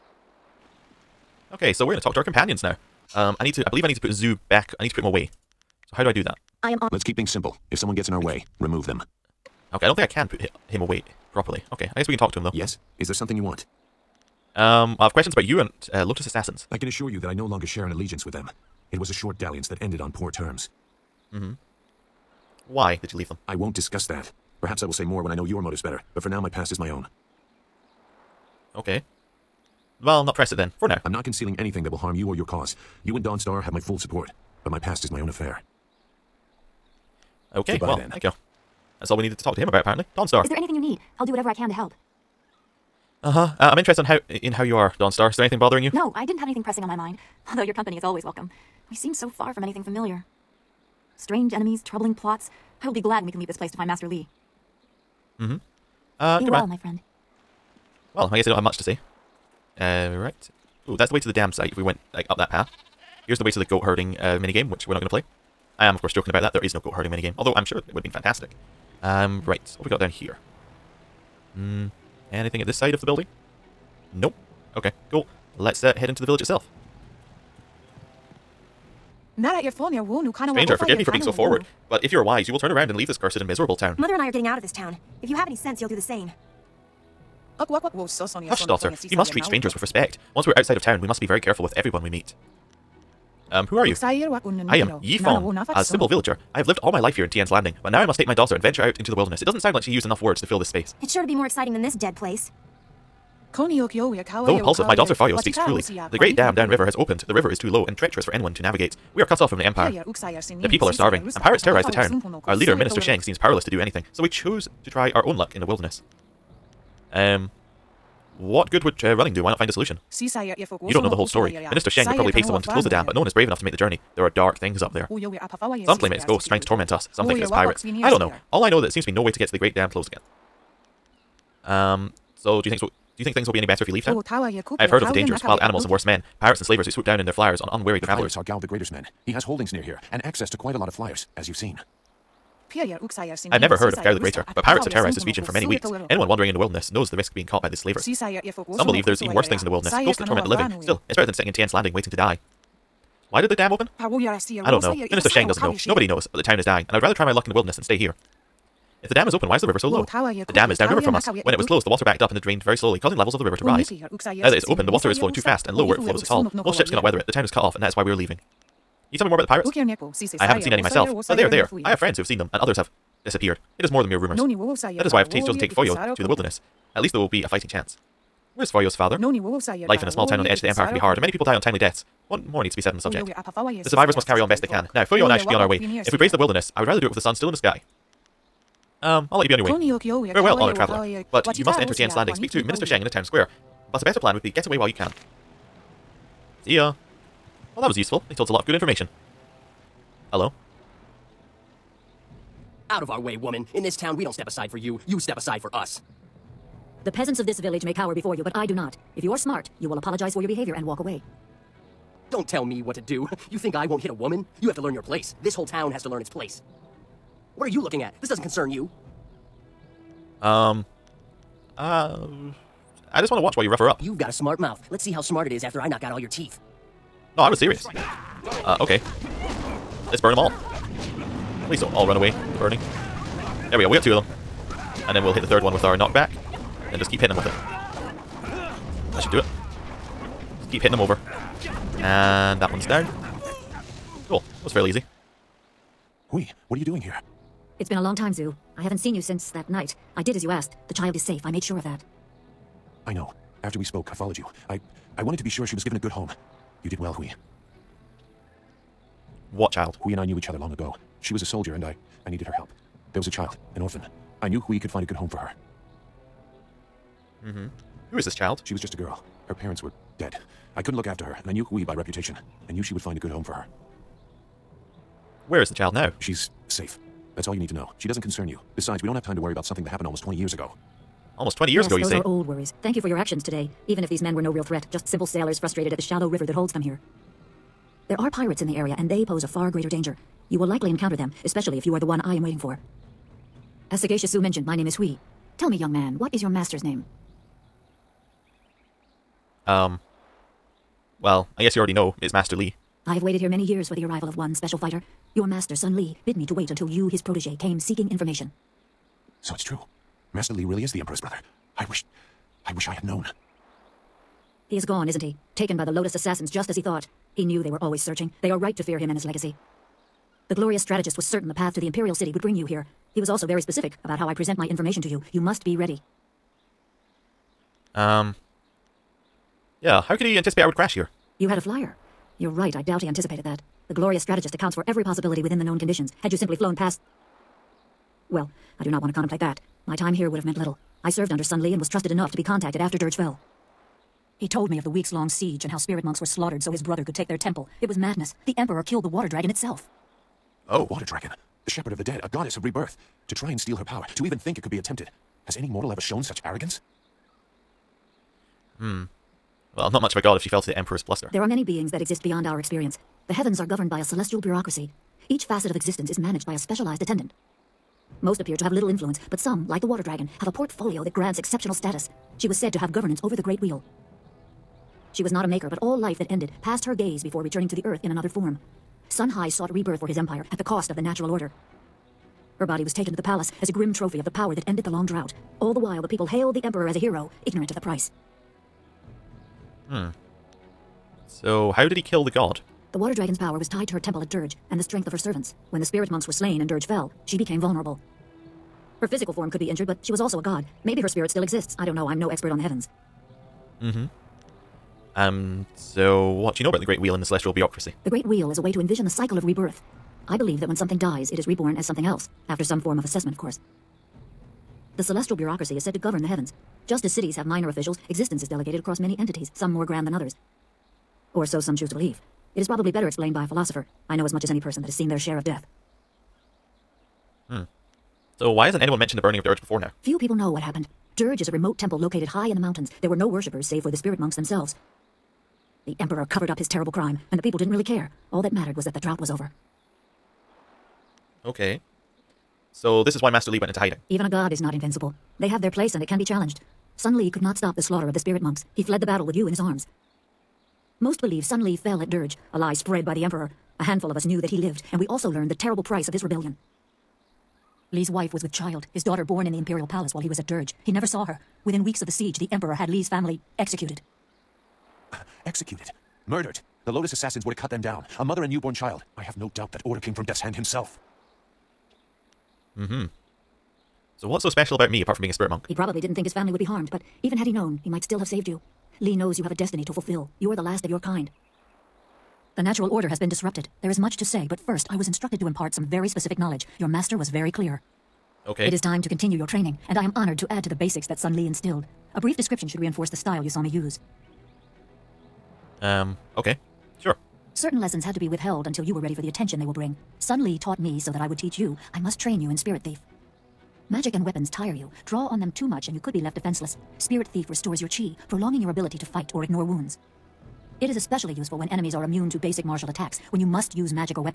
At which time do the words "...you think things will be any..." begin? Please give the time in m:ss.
2:13.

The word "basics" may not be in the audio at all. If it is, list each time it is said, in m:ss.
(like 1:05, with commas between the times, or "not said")
8:10, 8:32.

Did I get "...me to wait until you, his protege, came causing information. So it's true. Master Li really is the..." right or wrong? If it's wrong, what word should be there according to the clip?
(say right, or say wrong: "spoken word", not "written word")
wrong: "seeking", not "causing".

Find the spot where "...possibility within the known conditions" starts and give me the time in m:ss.
5:35.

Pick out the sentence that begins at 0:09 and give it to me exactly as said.
Okay, I don't think I can put him away properly.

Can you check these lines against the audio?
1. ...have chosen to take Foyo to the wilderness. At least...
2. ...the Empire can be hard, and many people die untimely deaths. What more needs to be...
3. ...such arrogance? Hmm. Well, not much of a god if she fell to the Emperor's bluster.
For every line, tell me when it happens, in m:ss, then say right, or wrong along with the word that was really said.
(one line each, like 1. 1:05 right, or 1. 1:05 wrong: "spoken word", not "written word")
1. 2:55 right
2. 3:00 right
3. 5:56 right.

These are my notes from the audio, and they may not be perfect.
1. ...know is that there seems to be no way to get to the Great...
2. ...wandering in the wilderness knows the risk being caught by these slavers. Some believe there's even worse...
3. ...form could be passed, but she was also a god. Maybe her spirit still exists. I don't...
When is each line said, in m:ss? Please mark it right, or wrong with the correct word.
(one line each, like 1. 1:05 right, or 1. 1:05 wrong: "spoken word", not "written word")
1. 2:08 right
2. 2:26 right
3. 6:39 wrong: "injured", not "passed".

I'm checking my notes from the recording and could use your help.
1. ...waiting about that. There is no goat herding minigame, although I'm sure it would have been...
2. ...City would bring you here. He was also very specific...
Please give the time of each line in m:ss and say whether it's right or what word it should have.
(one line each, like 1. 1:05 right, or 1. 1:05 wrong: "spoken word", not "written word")
1. 1:06 wrong: "joking", not "waiting"
2. 5:22 right.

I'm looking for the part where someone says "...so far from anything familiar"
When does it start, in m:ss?
0:49.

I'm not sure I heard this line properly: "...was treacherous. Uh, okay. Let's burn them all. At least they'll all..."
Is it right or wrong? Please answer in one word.
wrong.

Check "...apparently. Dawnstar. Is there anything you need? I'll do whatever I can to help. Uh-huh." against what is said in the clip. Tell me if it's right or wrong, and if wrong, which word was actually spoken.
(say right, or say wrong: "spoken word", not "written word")
right.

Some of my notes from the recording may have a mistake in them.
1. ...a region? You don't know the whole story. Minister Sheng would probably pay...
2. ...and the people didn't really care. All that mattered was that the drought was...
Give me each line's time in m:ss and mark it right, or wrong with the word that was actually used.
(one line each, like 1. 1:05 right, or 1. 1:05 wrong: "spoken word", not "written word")
1. 1:59 wrong: "solution", not "region"
2. 7:17 right.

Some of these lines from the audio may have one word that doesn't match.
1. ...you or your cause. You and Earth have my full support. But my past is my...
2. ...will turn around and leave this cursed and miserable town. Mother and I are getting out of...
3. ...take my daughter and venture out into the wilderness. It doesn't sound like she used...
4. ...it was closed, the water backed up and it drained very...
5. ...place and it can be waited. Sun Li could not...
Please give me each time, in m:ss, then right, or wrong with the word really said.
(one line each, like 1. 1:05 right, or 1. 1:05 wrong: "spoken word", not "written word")
1. 0:32 wrong: "Dawnstar", not "Earth"
2. 1:22 right
3. 1:38 right
4. 2:41 right
5. 7:25 wrong: "challenged", not "waited".